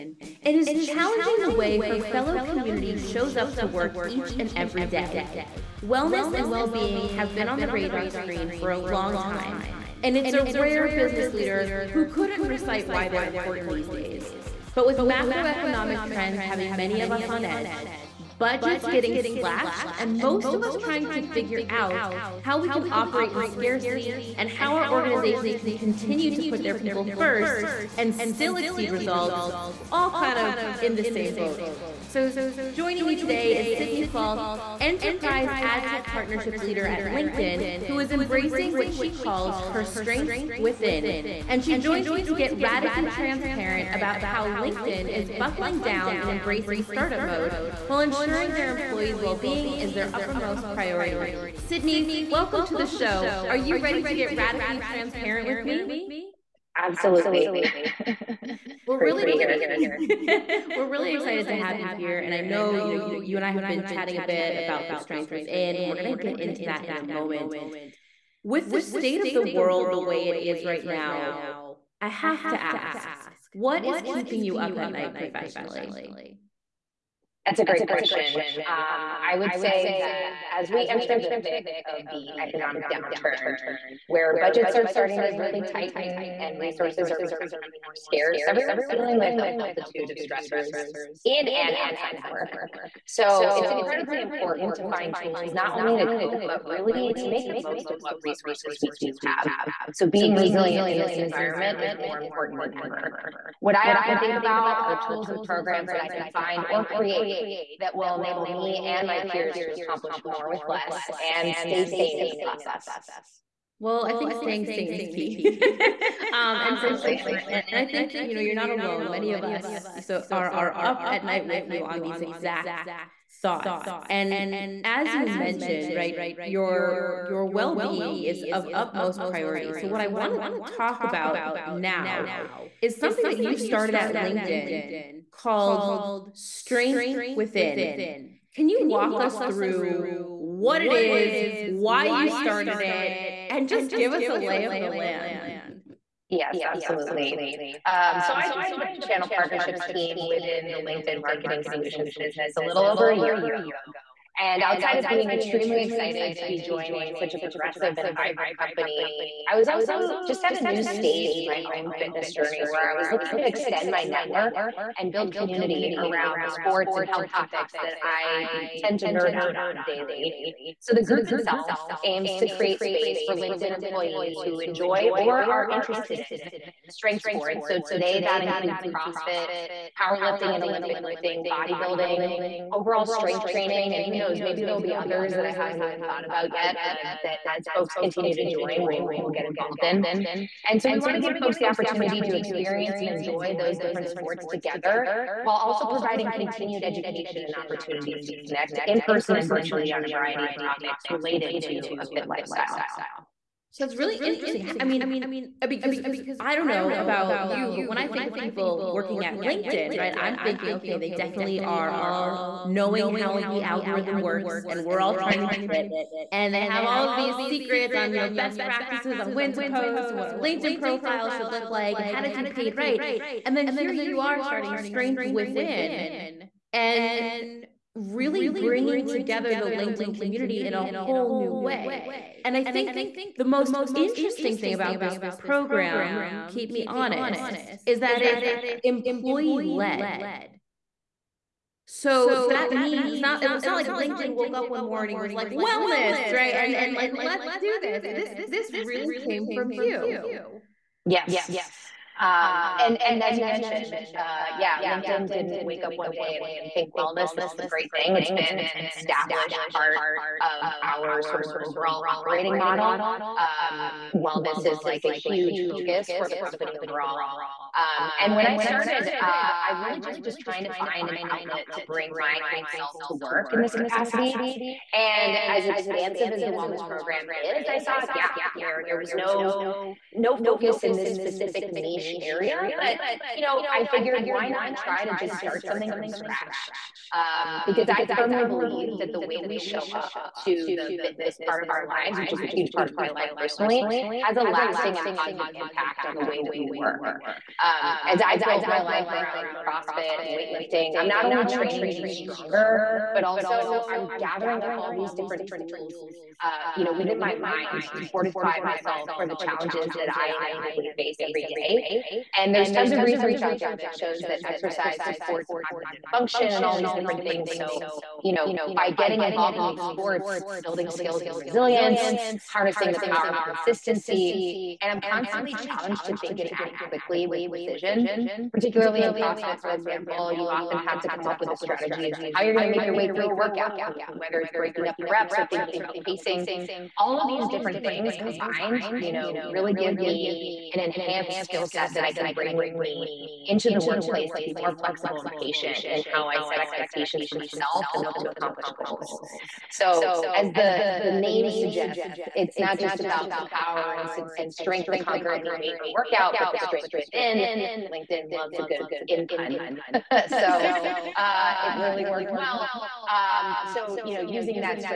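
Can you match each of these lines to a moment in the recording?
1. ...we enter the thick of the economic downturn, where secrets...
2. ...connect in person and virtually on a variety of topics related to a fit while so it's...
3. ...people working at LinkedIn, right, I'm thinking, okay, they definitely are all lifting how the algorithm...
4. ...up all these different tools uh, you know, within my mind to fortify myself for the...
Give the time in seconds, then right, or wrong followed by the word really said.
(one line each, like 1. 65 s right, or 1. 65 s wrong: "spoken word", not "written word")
1. 80 s wrong: "budgets", not "secrets"
2. 198 s wrong: "lifestyle", not "while"
3. 208 s wrong: "knowing", not "lifting"
4. 304 s right.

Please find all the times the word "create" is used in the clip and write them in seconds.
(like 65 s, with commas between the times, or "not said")
106 s, 172 s.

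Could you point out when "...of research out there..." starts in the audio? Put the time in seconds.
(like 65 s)
312 s.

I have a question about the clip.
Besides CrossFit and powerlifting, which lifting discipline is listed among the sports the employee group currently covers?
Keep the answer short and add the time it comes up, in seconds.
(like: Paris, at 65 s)
Olympic lifting, at 180 s.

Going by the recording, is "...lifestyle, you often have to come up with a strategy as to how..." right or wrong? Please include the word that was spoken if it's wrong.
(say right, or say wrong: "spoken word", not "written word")
wrong: "example", not "lifestyle".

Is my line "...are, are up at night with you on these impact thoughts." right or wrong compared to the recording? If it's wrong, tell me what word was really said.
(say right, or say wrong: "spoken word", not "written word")
wrong: "exact", not "impact".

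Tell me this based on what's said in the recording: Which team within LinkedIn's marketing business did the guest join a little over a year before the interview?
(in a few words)
Channel partnerships.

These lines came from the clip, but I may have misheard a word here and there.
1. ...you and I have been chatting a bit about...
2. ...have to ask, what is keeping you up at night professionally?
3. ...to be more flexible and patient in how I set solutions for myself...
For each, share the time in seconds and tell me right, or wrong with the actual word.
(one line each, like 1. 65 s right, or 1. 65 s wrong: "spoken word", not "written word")
1. 63 s right
2. 72 s right
3. 344 s wrong: "expectations", not "solutions".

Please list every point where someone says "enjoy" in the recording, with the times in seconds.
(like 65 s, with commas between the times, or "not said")
174 s, 193 s.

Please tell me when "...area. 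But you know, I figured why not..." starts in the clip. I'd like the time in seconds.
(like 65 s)
282 s.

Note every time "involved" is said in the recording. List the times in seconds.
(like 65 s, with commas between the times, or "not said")
189 s, 319 s.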